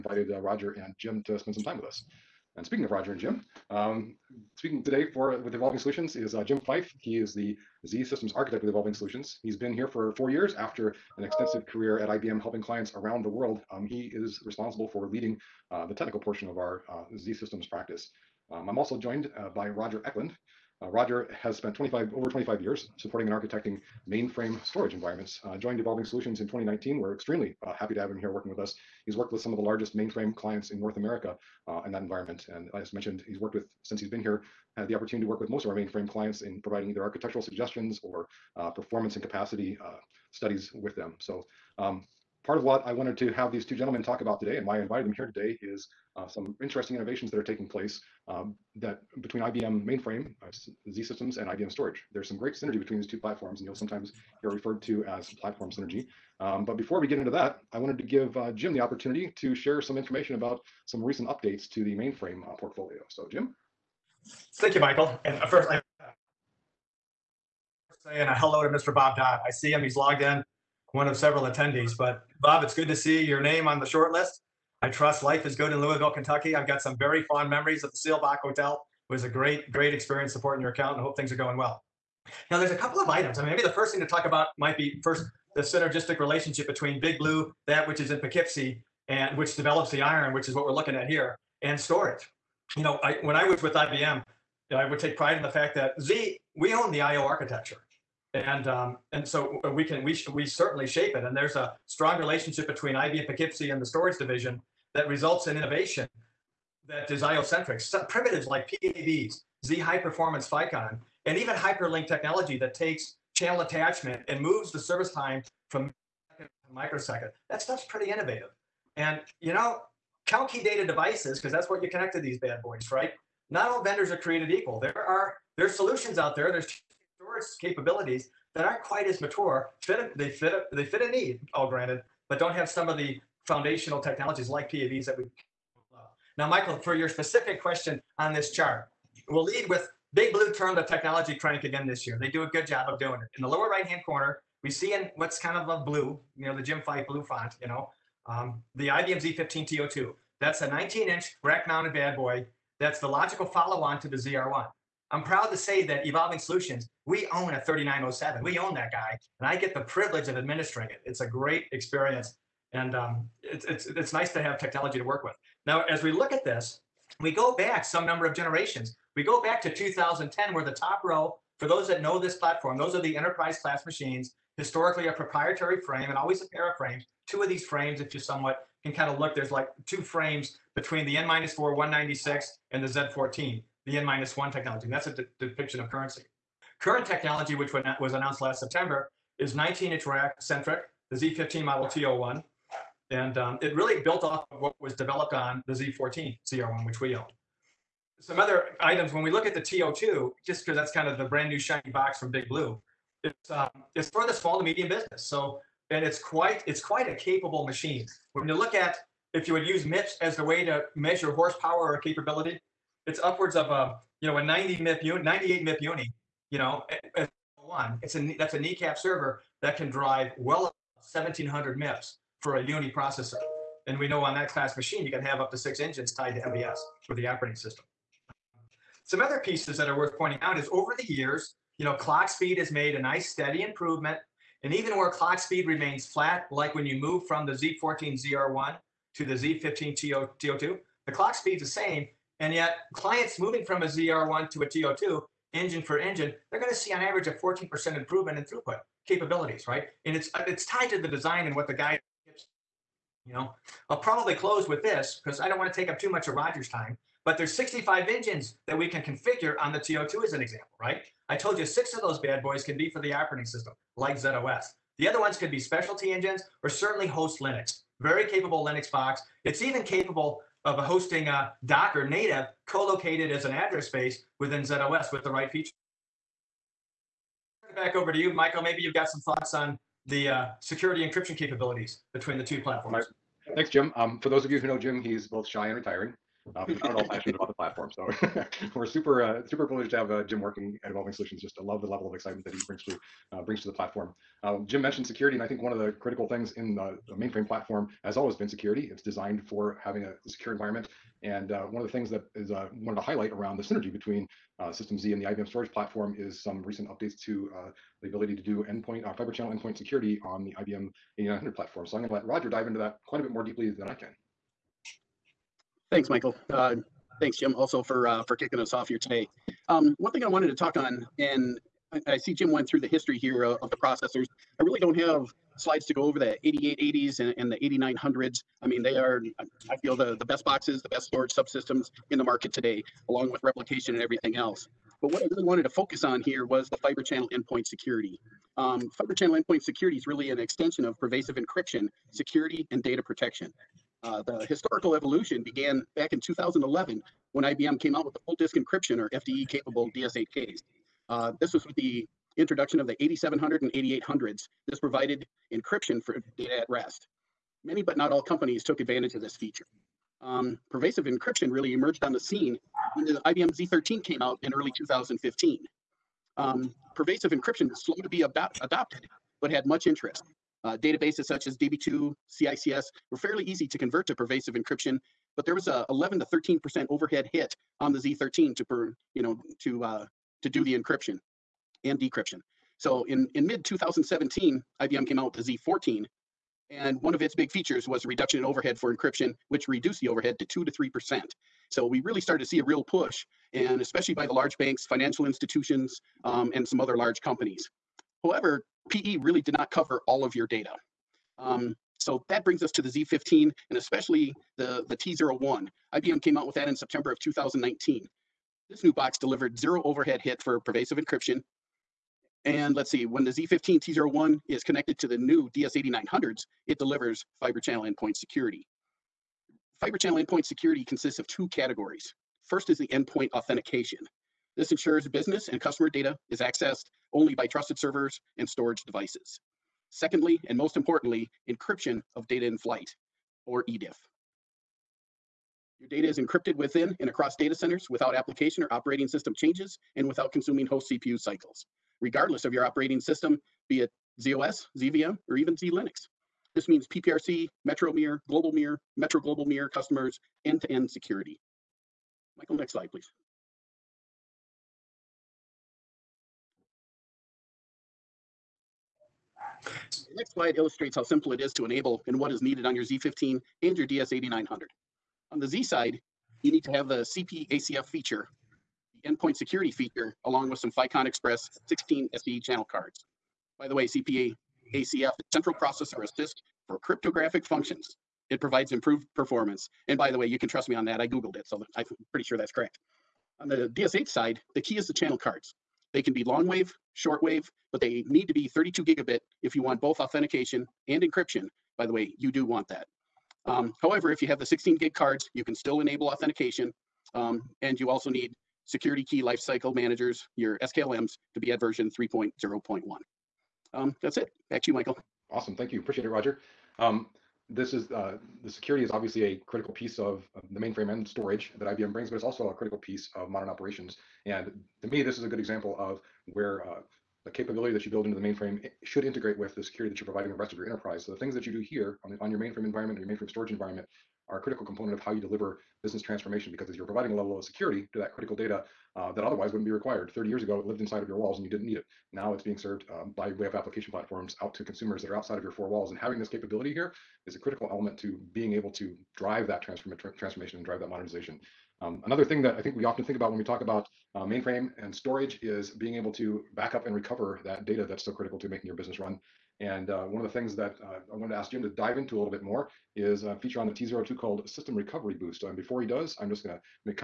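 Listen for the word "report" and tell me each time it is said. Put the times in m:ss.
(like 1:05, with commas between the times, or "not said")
not said.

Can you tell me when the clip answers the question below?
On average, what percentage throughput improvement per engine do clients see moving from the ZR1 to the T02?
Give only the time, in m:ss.
4:07.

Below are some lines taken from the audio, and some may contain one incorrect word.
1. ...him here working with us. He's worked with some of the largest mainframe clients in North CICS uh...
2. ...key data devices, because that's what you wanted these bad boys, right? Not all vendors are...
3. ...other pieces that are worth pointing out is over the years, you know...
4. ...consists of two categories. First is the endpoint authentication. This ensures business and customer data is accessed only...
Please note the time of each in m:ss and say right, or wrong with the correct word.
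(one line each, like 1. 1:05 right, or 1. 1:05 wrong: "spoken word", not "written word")
1. 0:28 wrong: "America", not "CICS"
2. 2:00 wrong: "connected", not "wanted"
3. 3:49 right
4. 7:00 right.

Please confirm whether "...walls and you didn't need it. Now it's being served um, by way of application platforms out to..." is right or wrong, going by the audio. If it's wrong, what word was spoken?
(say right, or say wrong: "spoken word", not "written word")
right.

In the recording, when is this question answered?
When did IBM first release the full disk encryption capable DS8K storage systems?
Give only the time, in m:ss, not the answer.
5:46.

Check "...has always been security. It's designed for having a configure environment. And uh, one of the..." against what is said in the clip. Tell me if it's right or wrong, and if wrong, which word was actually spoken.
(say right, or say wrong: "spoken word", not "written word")
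wrong: "secure", not "configure".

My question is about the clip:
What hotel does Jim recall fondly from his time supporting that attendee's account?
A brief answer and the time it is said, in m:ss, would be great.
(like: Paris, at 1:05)
Seelbach Hotel, at 1:17.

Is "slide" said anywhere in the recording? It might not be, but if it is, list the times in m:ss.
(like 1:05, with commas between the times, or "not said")
5:25, 7:32, 7:40.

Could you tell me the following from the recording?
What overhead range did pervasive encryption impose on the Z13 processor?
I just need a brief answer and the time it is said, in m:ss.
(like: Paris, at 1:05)
11 to 13 percent, at 6:15.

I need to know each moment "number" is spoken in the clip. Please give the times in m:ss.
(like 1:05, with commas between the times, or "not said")
2:48.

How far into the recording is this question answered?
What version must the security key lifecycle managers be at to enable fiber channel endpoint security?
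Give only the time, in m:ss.
8:21.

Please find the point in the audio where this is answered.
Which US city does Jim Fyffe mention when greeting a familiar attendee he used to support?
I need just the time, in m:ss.
1:15.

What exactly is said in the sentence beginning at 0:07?
He is the Z Systems architect with Evolving Solutions.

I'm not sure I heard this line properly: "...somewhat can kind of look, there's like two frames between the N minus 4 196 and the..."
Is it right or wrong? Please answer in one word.
right.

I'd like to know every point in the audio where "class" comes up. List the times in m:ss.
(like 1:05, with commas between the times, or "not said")
2:53, 3:44.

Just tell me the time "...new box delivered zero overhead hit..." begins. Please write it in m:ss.
6:48.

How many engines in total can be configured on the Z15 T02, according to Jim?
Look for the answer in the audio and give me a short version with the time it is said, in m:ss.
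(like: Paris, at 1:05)
65, at 4:17.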